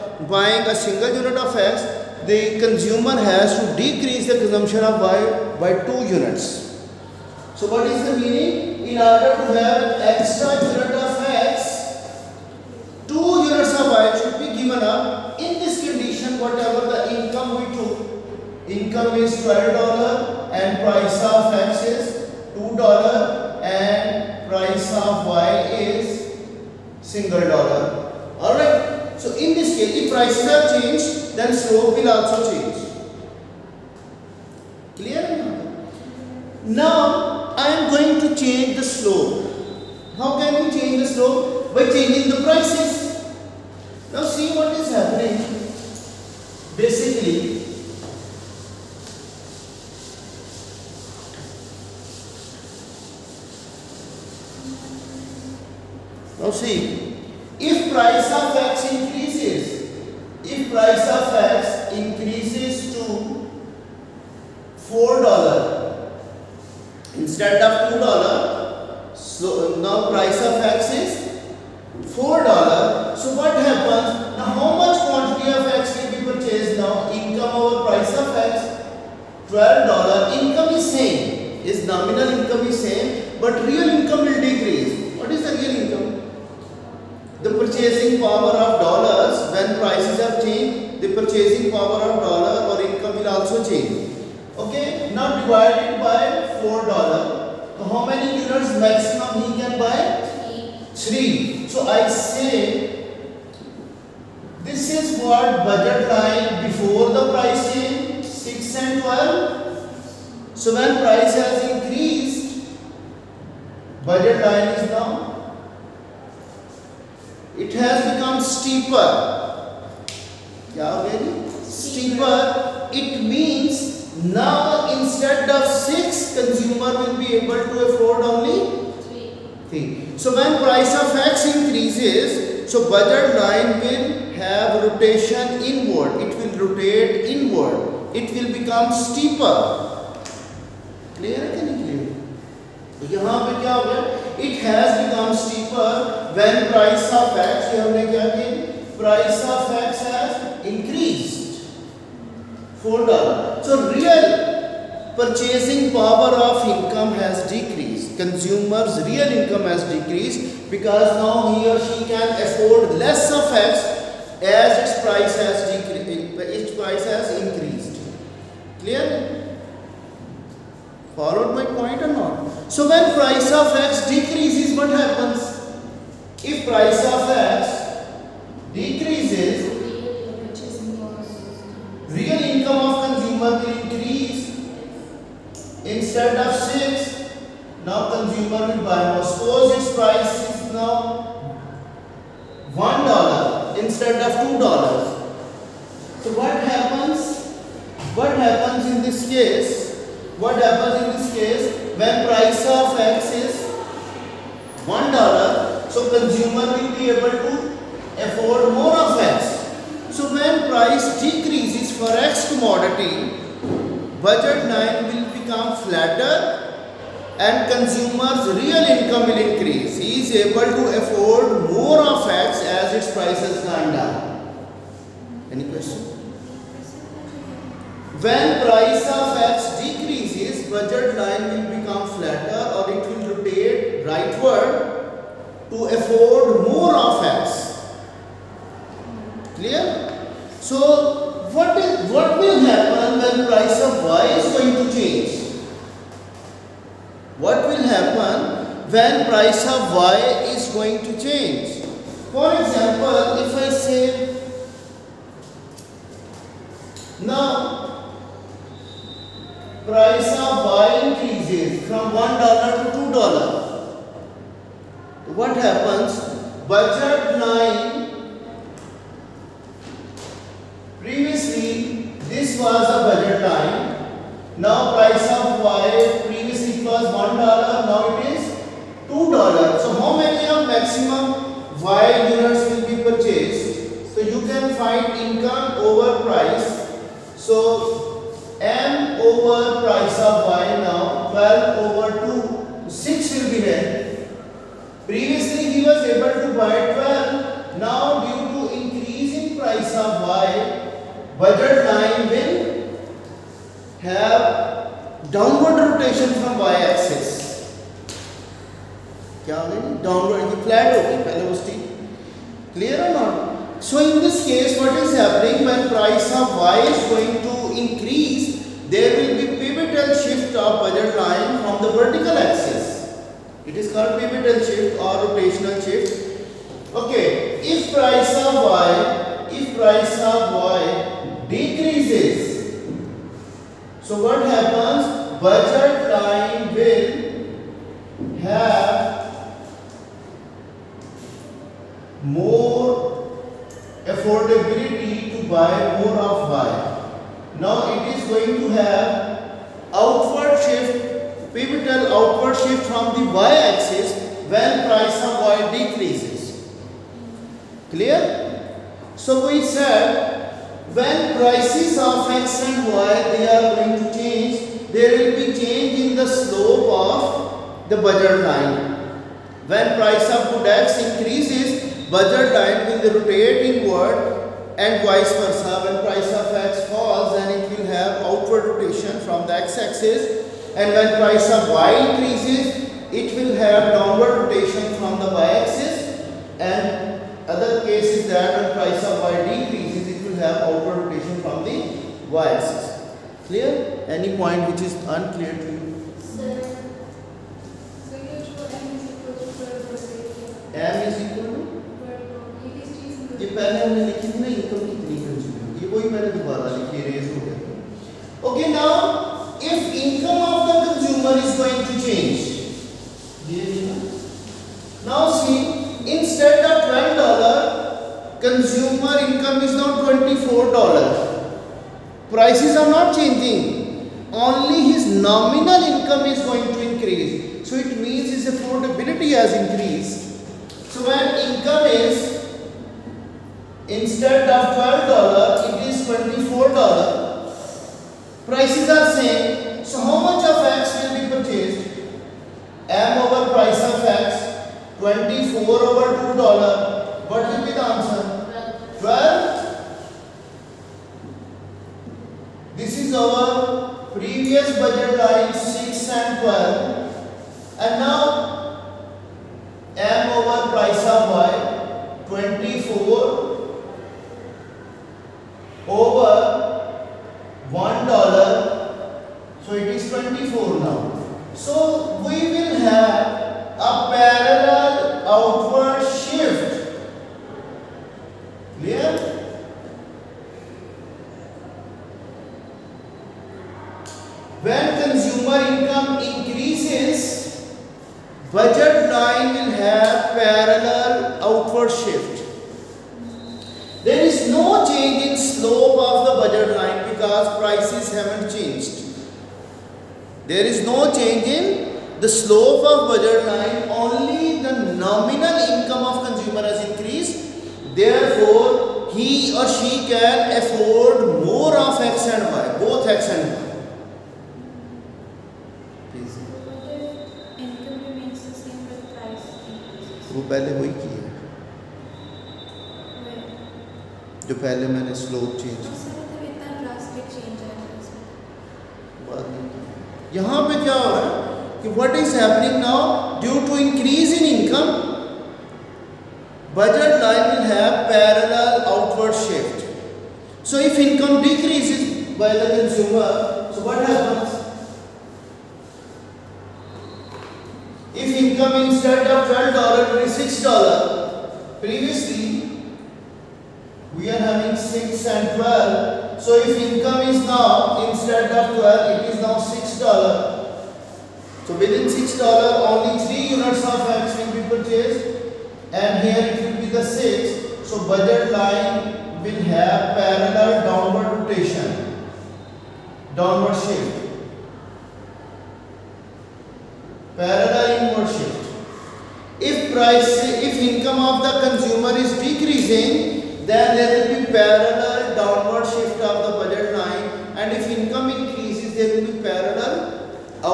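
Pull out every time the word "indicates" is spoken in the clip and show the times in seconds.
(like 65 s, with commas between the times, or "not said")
not said.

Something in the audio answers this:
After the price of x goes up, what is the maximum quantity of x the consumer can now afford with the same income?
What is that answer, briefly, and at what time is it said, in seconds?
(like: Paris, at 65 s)
3, at 97 s.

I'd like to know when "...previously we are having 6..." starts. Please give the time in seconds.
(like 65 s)
551 s.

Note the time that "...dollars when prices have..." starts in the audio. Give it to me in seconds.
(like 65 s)
88 s.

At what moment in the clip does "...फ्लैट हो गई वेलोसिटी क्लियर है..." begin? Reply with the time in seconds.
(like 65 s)
310 s.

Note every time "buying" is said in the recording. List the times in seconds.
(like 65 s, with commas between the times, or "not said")
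0 s.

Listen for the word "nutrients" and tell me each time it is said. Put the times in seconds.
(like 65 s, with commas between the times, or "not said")
not said.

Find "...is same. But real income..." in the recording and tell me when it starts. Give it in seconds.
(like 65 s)
82 s.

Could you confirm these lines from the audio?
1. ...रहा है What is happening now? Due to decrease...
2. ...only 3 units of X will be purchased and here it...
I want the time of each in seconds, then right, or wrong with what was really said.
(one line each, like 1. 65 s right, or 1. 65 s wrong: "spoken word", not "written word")
1. 531 s wrong: "increase", not "decrease"
2. 562 s right.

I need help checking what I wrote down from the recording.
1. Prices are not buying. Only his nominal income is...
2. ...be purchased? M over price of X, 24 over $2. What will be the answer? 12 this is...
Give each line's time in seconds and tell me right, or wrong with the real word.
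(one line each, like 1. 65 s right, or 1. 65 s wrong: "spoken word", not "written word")
1. 422 s wrong: "changing", not "buying"
2. 441 s right.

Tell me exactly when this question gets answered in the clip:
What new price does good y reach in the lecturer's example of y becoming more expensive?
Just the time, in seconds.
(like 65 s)
257 s.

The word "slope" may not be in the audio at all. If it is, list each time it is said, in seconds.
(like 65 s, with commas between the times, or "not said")
31 s, 366 s, 502 s.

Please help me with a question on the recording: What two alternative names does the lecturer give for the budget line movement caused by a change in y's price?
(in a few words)
pivotal shift or rotational shift.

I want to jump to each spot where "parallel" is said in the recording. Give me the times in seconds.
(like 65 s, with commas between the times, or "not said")
538 s, 570 s, 577 s, 584 s, 589 s.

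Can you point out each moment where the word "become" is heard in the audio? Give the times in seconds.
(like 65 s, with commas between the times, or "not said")
118 s, 138 s, 145 s, 215 s, 231 s.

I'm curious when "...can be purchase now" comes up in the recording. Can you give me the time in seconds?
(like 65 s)
76 s.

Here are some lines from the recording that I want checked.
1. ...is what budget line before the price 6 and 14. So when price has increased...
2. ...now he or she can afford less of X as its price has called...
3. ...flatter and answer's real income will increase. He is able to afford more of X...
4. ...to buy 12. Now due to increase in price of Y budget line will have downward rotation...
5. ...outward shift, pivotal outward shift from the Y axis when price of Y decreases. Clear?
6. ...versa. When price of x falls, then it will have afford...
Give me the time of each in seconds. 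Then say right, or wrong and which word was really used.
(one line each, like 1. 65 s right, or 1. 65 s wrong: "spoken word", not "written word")
1. 104 s wrong: "12", not "14"
2. 161 s wrong: "decreased", not "called"
3. 215 s wrong: "consumer", not "answer"
4. 296 s right
5. 349 s right
6. 375 s wrong: "outward", not "afford".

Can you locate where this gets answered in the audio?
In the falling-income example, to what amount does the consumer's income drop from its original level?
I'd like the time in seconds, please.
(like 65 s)
559 s.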